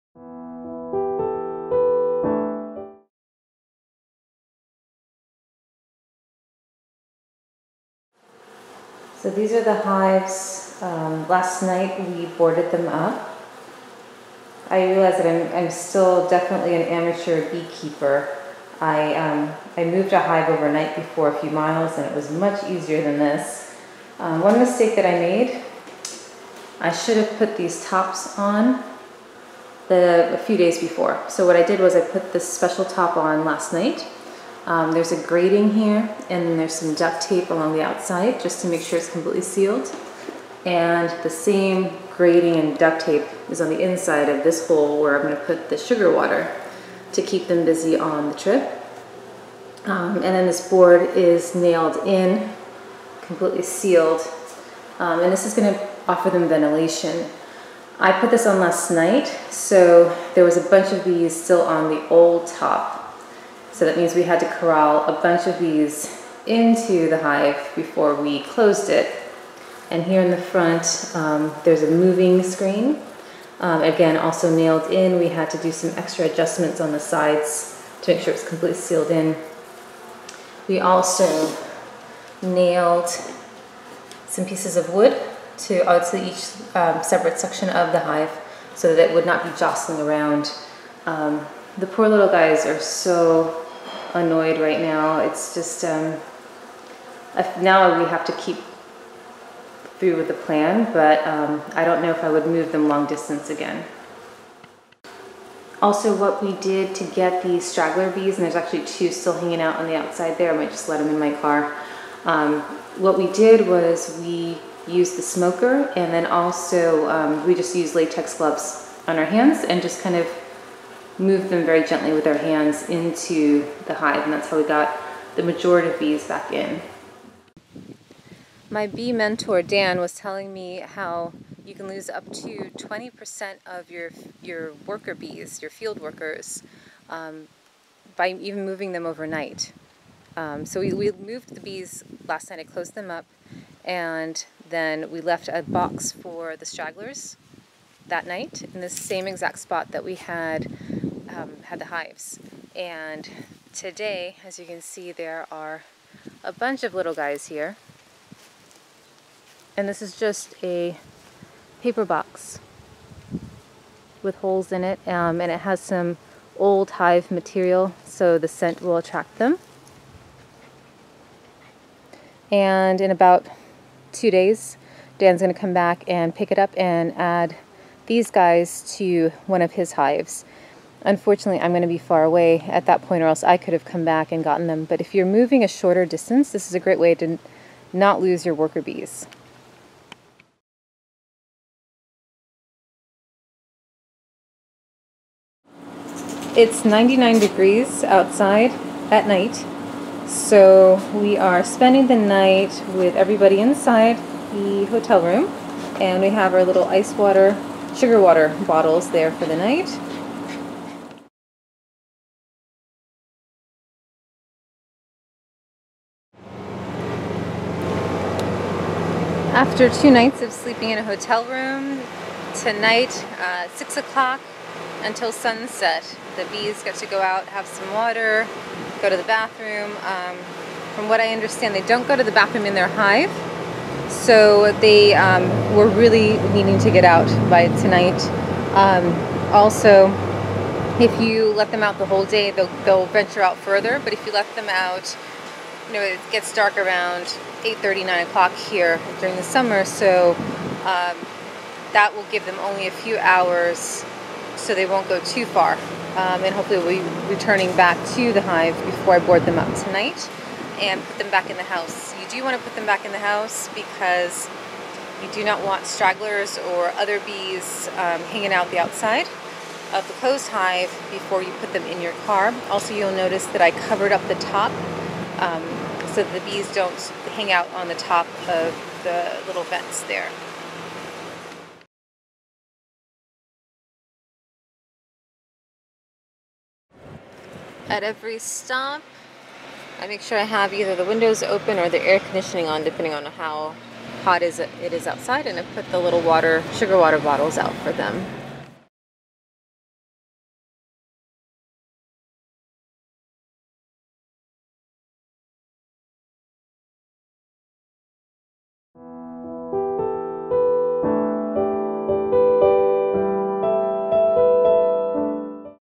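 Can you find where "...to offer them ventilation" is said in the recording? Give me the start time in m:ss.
0:55.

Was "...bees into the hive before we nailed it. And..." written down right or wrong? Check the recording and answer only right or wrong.
wrong.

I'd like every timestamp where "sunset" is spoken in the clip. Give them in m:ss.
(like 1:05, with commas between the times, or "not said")
3:45.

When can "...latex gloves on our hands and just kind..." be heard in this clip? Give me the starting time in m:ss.
1:57.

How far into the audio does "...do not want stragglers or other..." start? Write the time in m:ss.
4:25.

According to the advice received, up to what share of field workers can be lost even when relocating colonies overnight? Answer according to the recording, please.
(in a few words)
20%.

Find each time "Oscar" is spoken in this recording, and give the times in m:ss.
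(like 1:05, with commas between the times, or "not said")
not said.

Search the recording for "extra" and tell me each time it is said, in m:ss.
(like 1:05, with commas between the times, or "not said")
1:15.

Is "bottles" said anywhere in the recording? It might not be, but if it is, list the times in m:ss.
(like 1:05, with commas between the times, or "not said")
3:28, 4:57.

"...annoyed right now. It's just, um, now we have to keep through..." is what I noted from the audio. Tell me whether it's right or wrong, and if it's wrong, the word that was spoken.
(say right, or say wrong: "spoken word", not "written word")
right.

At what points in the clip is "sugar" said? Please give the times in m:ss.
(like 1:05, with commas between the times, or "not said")
0:45, 3:27, 4:56.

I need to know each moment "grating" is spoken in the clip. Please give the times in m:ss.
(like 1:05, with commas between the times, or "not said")
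0:35, 0:42.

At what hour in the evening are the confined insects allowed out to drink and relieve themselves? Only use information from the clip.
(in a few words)
6 o'clock.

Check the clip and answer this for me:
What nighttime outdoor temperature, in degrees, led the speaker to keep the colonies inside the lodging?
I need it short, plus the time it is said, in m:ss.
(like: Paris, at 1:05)
99, at 3:16.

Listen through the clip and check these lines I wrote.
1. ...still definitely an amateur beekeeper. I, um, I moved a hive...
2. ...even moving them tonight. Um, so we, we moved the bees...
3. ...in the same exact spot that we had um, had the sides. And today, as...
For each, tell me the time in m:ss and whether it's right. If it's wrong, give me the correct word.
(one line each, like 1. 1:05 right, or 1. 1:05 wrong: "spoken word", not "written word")
1. 0:15 right
2. 2:18 wrong: "overnight", not "tonight"
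3. 2:28 wrong: "hives", not "sides".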